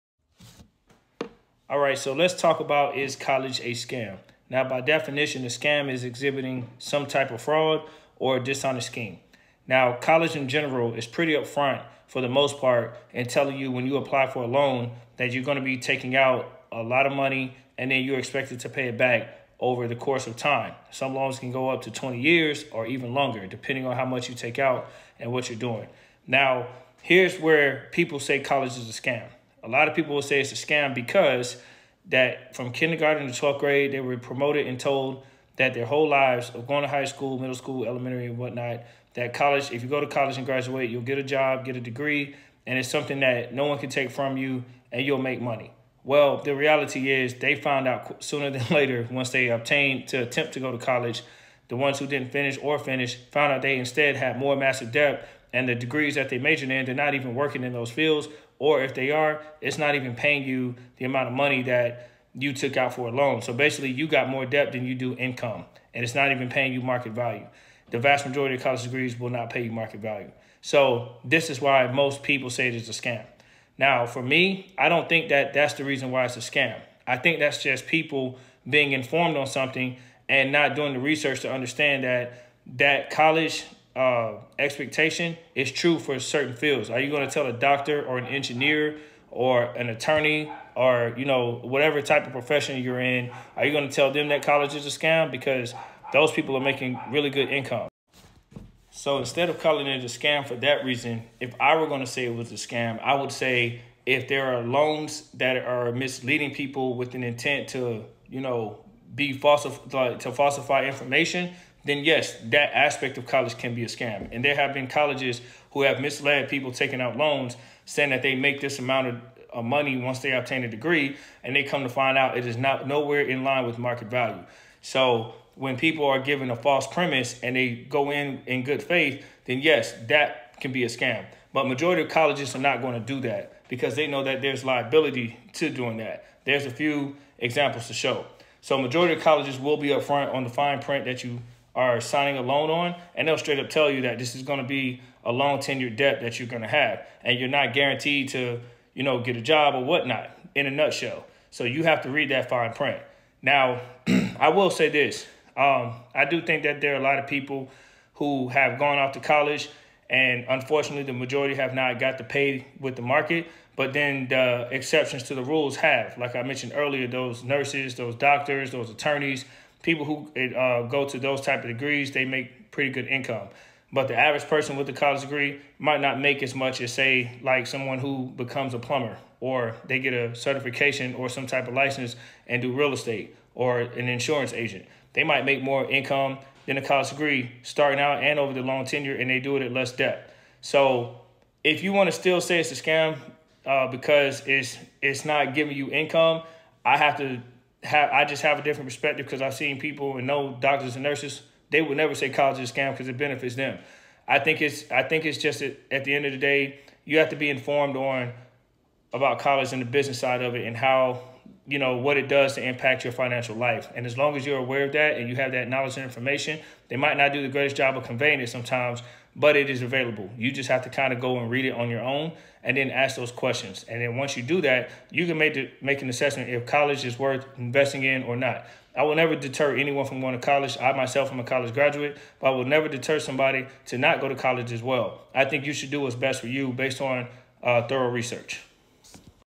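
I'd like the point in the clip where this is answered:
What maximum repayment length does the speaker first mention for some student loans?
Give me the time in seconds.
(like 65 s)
21 s.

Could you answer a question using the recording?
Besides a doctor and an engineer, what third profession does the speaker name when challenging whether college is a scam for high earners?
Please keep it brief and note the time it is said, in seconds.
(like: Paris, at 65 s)
attorney, at 89 s.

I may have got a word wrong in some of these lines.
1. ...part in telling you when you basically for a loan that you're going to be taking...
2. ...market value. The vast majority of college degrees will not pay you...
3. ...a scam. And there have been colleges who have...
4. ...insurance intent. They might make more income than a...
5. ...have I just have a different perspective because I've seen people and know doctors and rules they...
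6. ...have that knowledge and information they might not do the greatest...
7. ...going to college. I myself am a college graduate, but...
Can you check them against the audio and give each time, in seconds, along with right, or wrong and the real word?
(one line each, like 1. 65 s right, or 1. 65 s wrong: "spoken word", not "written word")
1. 12 s wrong: "apply", not "basically"
2. 66 s right
3. 113 s right
4. 184 s wrong: "agent", not "intent"
5. 197 s wrong: "nurses", not "rules"
6. 215 s right
7. 230 s right.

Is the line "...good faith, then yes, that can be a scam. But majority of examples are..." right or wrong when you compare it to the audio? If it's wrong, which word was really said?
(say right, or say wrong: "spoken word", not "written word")
wrong: "colleges", not "examples".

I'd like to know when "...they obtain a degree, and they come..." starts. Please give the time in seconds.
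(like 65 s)
120 s.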